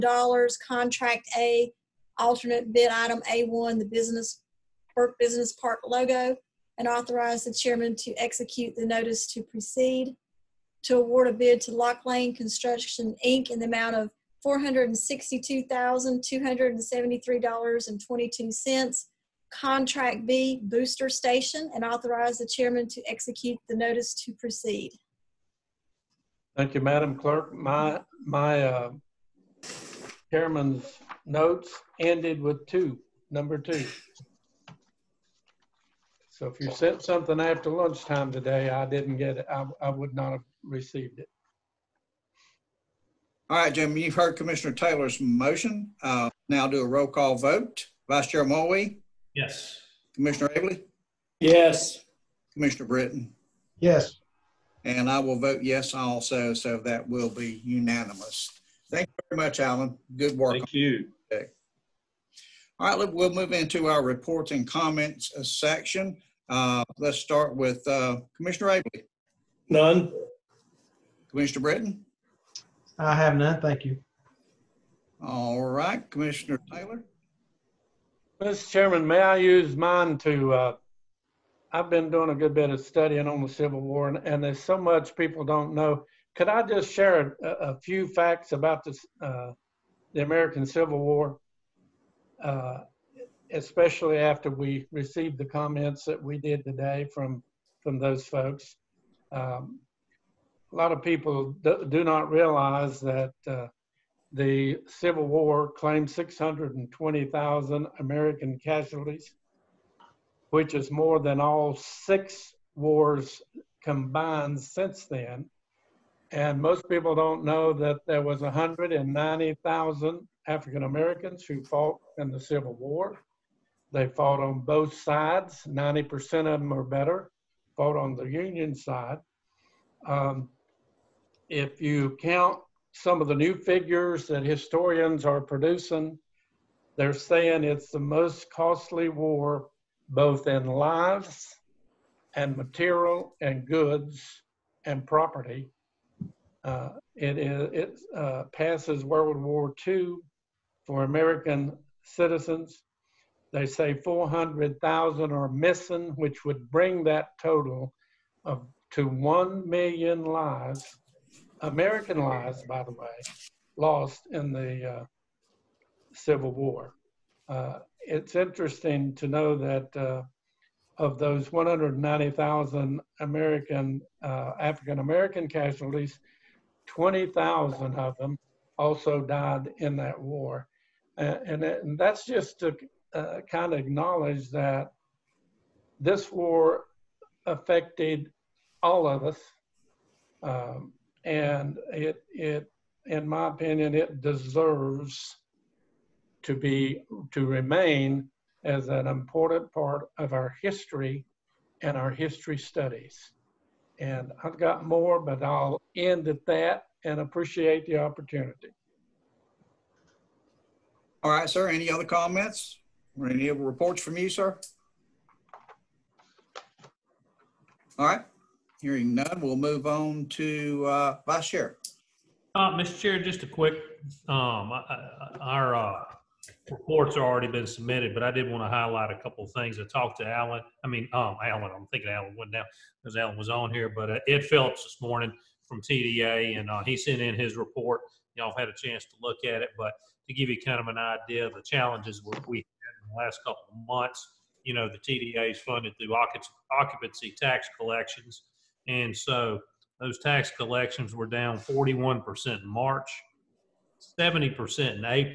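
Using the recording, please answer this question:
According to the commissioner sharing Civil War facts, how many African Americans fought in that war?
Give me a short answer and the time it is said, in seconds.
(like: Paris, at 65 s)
190,000, at 118 s.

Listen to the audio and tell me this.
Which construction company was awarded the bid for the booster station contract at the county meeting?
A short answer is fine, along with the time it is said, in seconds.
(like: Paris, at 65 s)
Lock Lane Construction Inc., at 11 s.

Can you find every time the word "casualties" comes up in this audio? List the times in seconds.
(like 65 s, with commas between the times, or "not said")
108 s, 175 s.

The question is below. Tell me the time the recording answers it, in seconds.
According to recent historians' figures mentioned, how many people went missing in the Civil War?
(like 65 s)
154 s.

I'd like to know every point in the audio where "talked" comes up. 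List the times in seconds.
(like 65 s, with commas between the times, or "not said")
229 s.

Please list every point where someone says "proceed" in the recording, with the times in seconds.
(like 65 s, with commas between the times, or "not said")
9 s, 24 s.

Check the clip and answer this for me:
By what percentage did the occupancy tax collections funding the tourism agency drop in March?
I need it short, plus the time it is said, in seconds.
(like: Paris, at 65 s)
41%, at 251 s.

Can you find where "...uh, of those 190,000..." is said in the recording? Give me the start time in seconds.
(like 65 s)
169 s.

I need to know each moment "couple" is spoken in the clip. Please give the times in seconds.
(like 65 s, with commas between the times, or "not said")
229 s, 243 s.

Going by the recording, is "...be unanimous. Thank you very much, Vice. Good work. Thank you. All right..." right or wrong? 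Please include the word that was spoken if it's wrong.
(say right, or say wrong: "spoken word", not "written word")
wrong: "Alan", not "Vice".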